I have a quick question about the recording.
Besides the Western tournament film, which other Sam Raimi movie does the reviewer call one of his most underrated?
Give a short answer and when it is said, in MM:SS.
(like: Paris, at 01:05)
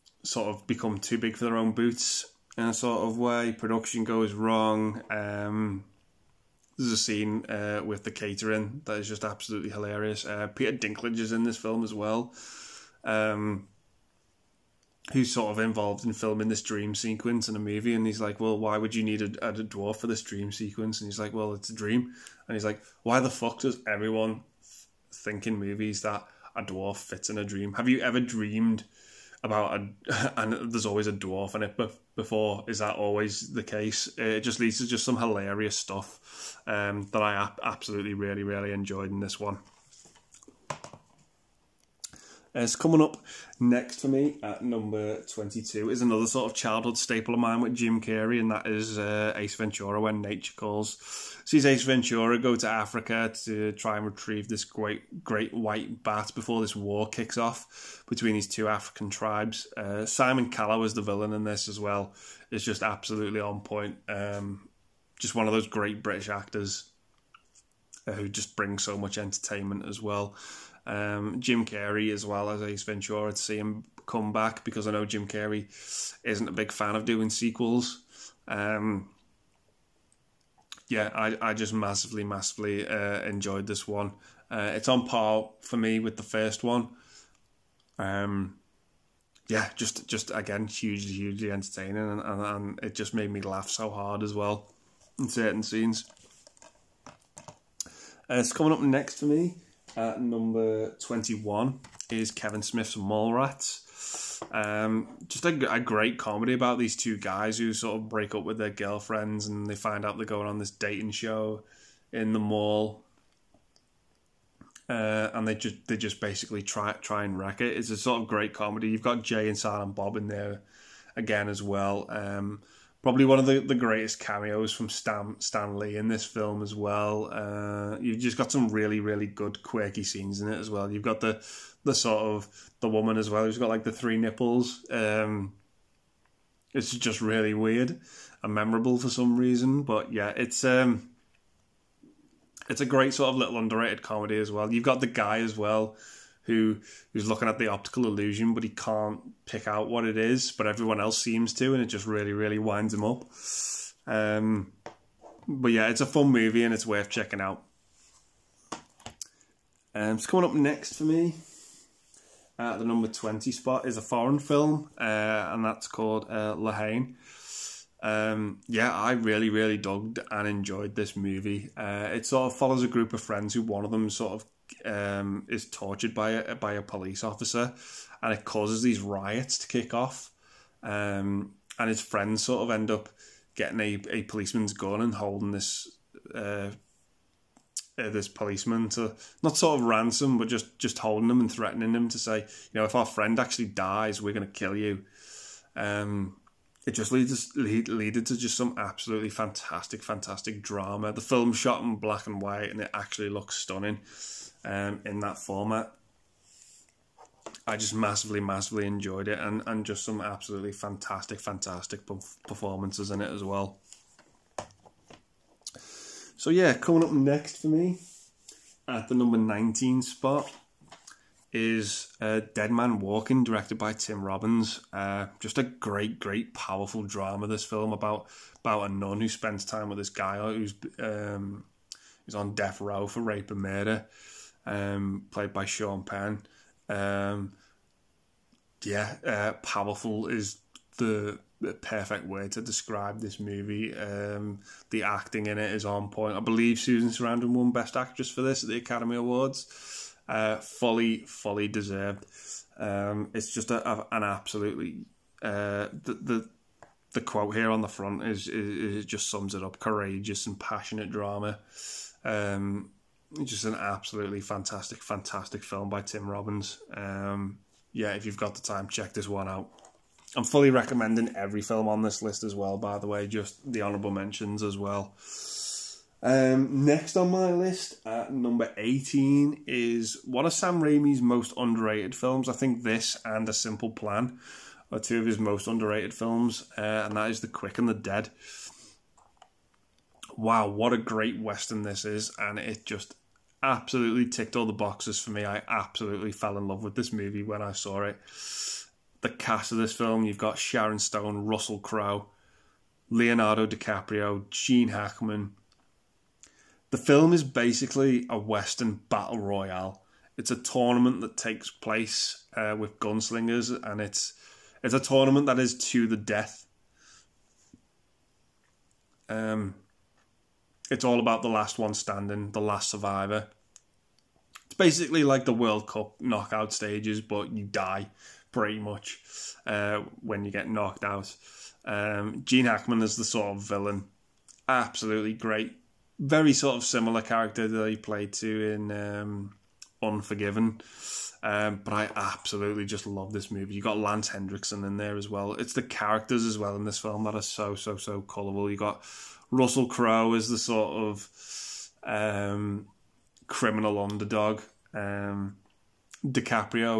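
A Simple Plan, at 04:43.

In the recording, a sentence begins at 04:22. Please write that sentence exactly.
Um, just an absolutely fantastic, fantastic film by Tim Robbins.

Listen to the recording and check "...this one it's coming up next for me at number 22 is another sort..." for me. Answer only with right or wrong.
right.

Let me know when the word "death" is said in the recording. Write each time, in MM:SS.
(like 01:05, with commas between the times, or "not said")
03:52, 05:16.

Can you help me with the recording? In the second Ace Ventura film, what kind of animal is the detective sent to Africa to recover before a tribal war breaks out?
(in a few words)
Great white bat.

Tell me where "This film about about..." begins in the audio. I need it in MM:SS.
03:47.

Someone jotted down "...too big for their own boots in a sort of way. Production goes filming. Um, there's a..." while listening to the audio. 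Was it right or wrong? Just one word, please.
wrong.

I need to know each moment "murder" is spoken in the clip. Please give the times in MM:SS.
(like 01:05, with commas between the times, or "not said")
03:53.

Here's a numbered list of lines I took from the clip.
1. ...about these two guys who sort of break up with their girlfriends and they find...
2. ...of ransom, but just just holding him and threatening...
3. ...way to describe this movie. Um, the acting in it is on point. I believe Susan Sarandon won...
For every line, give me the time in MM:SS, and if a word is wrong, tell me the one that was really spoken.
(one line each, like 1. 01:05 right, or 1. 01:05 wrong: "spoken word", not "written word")
1. 01:46 right
2. 03:09 right
3. 04:02 right.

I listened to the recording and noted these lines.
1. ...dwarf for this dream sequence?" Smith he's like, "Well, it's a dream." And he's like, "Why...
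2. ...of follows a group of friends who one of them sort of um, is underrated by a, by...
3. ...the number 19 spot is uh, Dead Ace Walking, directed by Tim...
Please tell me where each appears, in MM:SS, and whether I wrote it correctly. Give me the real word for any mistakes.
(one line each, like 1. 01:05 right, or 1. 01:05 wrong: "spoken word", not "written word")
1. 00:19 wrong: "And", not "Smith"
2. 02:52 wrong: "tortured", not "underrated"
3. 03:39 wrong: "Man", not "Ace".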